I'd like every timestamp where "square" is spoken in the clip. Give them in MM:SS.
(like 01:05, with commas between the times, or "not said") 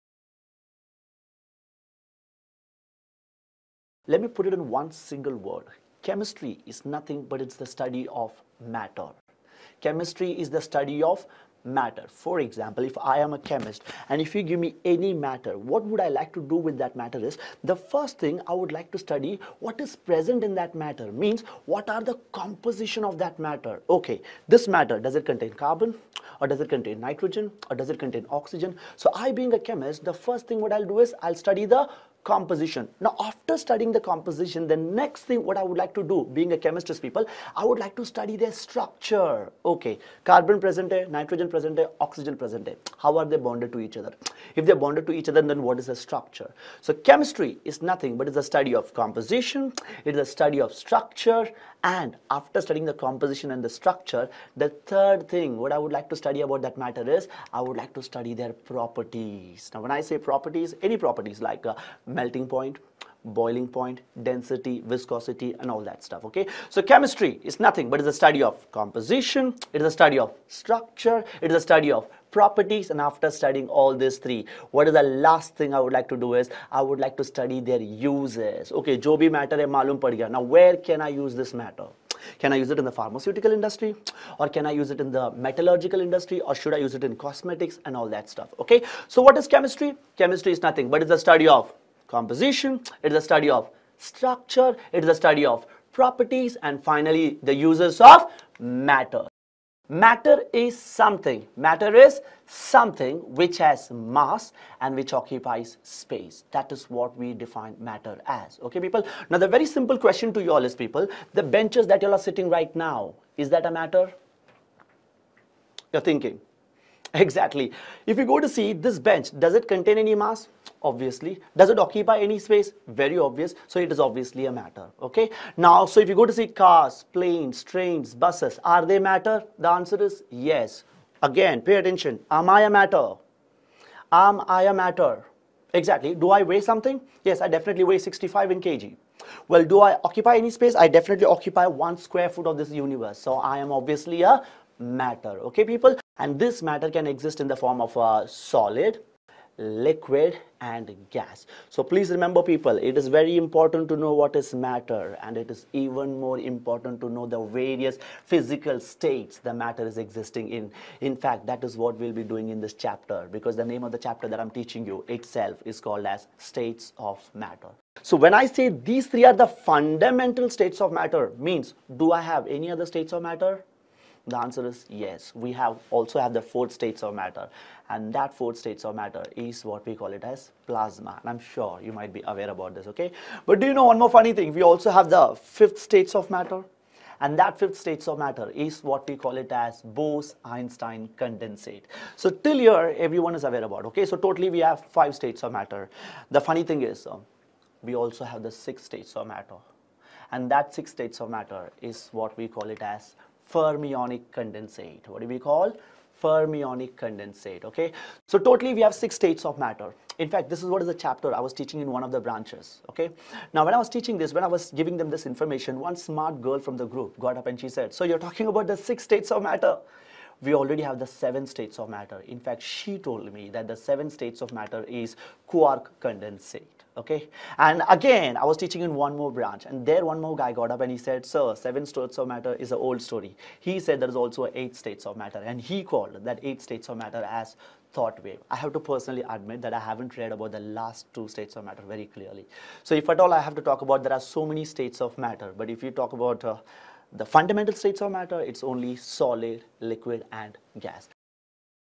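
02:21.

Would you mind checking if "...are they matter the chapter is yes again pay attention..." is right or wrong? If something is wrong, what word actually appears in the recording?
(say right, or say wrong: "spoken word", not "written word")
wrong: "answer", not "chapter".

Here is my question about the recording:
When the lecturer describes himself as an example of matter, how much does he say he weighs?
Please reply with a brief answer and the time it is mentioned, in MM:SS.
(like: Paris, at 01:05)
65 kg, at 02:17.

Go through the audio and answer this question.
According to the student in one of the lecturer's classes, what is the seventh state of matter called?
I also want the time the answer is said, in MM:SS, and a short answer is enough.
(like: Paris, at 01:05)
Quark condensate, at 03:45.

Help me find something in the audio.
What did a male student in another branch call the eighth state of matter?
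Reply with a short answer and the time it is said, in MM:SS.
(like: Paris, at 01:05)
Thought wave, at 03:57.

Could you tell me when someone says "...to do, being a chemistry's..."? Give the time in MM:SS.
00:35.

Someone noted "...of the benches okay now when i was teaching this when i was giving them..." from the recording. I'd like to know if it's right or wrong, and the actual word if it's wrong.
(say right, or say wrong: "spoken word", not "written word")
wrong: "branches", not "benches".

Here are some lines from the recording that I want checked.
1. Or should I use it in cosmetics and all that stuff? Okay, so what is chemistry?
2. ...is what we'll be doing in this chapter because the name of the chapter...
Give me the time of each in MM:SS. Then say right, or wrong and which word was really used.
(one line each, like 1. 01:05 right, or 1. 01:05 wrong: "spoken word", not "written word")
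1. 01:26 right
2. 02:41 right.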